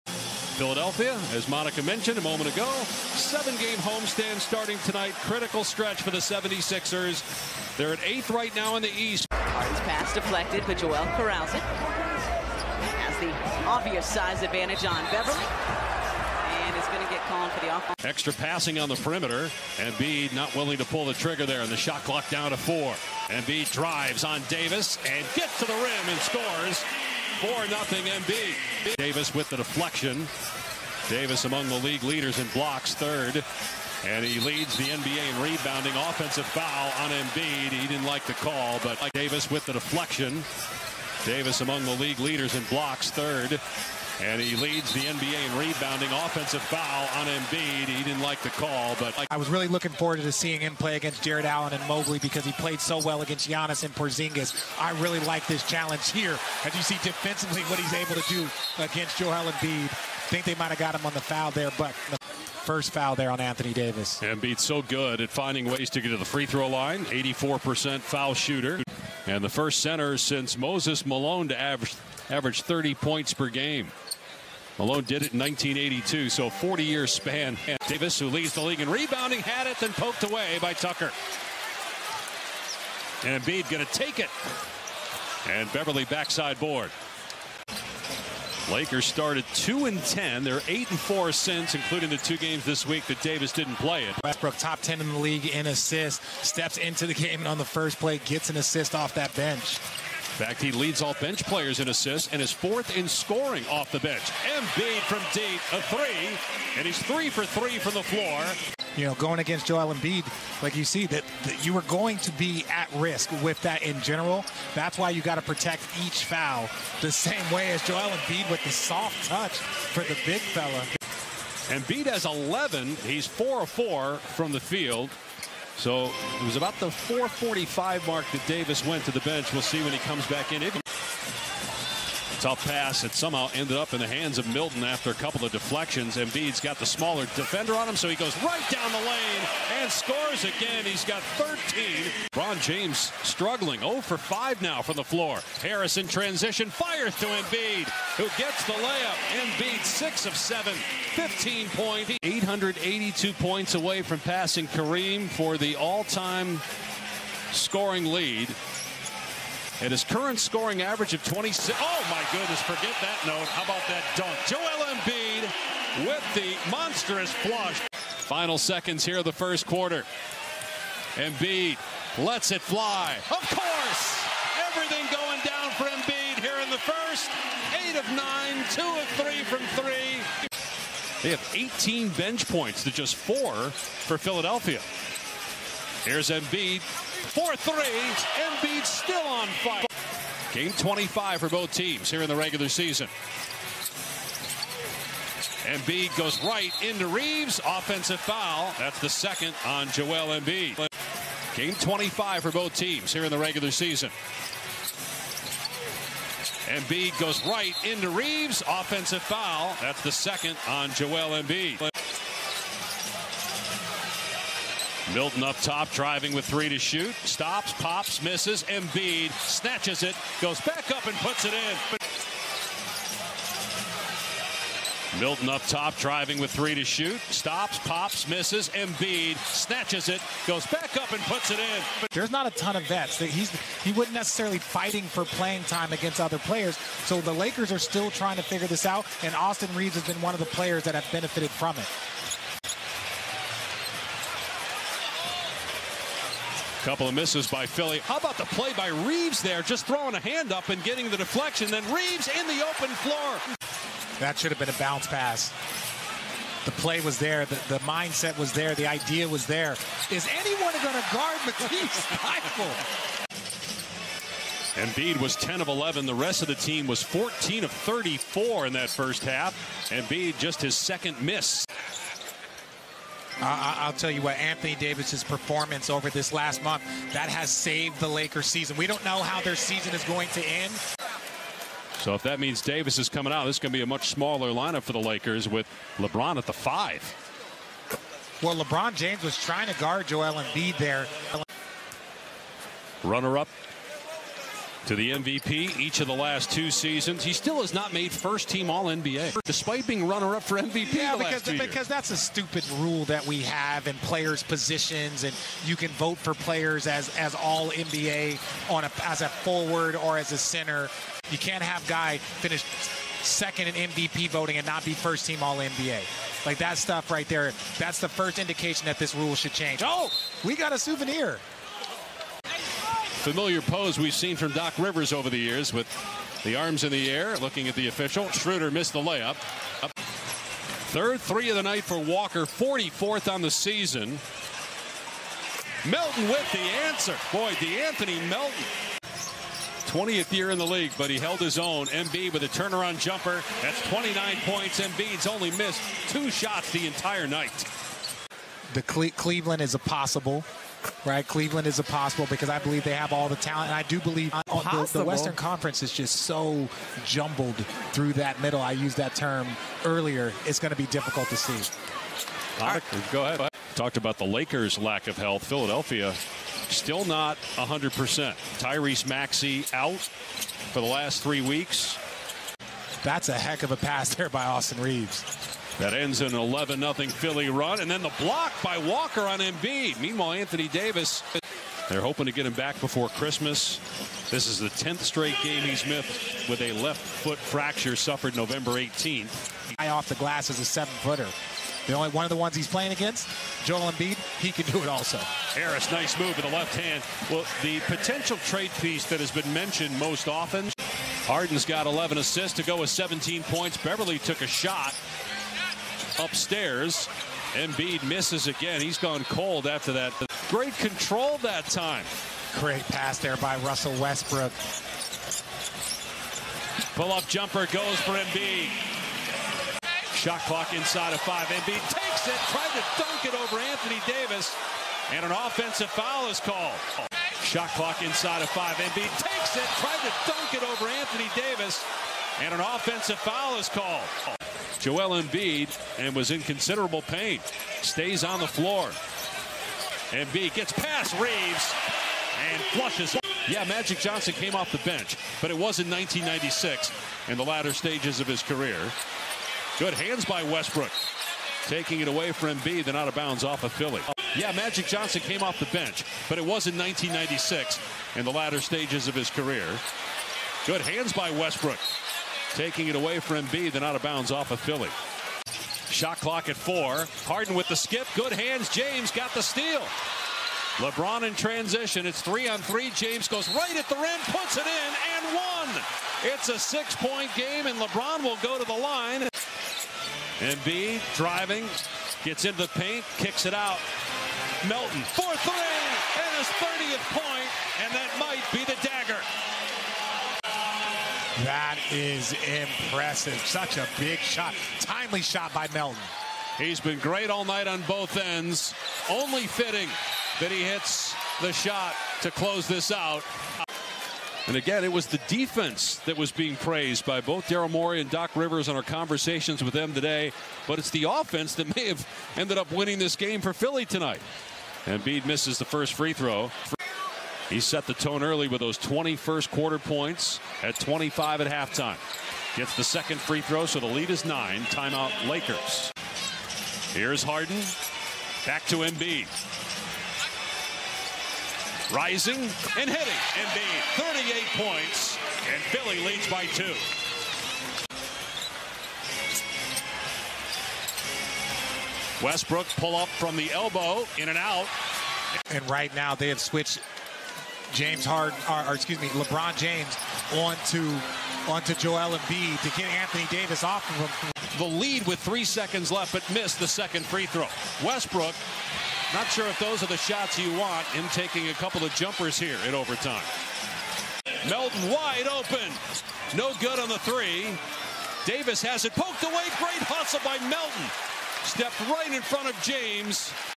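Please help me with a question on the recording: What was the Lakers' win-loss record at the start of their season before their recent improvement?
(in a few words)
2 and 10.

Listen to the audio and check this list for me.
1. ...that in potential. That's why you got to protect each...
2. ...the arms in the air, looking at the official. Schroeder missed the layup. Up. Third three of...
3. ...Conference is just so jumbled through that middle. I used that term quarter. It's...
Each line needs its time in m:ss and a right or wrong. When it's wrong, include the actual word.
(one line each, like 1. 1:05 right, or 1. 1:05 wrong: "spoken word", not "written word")
1. 1:53 wrong: "general", not "potential"
2. 5:26 right
3. 5:55 wrong: "earlier", not "quarter".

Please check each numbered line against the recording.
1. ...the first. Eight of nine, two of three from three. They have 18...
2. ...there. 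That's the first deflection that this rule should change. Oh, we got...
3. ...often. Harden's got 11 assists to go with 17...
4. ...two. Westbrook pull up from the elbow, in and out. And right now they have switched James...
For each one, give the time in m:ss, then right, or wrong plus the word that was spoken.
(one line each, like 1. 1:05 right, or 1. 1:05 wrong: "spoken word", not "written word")
1. 2:56 right
2. 5:17 wrong: "indication", not "deflection"
3. 6:40 right
4. 8:56 right.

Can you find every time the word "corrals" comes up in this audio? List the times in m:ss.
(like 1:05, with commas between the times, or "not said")
0:11.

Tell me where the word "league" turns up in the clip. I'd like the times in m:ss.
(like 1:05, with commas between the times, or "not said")
0:31, 0:41, 1:18, 1:35, 5:40.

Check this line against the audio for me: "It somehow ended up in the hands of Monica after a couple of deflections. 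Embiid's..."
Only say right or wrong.
wrong.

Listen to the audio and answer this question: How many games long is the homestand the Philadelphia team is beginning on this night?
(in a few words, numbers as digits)
7.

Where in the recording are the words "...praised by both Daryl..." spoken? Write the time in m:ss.
8:26.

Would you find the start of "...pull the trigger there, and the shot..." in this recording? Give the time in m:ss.
0:20.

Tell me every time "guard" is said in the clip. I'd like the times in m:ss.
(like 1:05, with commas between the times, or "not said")
4:21, 4:49.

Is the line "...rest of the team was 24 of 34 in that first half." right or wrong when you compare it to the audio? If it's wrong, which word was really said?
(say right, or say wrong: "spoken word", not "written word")
wrong: "14", not "24".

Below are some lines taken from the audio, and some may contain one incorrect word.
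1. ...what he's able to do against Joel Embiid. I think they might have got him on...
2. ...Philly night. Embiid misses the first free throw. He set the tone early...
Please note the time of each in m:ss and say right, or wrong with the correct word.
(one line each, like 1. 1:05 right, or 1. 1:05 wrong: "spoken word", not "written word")
1. 0:57 right
2. 8:33 wrong: "tonight", not "night".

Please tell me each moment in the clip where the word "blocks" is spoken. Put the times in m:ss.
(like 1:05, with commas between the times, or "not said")
0:32, 0:42, 6:18.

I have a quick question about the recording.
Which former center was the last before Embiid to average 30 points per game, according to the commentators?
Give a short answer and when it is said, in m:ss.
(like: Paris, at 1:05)
Moses Malone, at 1:10.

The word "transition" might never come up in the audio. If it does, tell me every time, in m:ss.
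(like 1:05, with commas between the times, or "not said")
2:26, 7:51.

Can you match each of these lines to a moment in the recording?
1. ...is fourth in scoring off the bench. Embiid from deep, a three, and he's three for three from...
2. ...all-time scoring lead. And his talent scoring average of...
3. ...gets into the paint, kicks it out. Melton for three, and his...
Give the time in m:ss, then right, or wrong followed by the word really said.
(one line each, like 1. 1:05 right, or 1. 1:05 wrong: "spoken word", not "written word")
1. 1:42 right
2. 2:35 wrong: "current", not "talent"
3. 8:02 right.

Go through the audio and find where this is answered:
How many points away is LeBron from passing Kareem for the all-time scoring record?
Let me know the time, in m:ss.
2:32.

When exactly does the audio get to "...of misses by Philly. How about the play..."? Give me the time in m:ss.
4:07.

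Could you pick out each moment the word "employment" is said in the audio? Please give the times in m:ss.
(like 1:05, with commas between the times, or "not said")
not said.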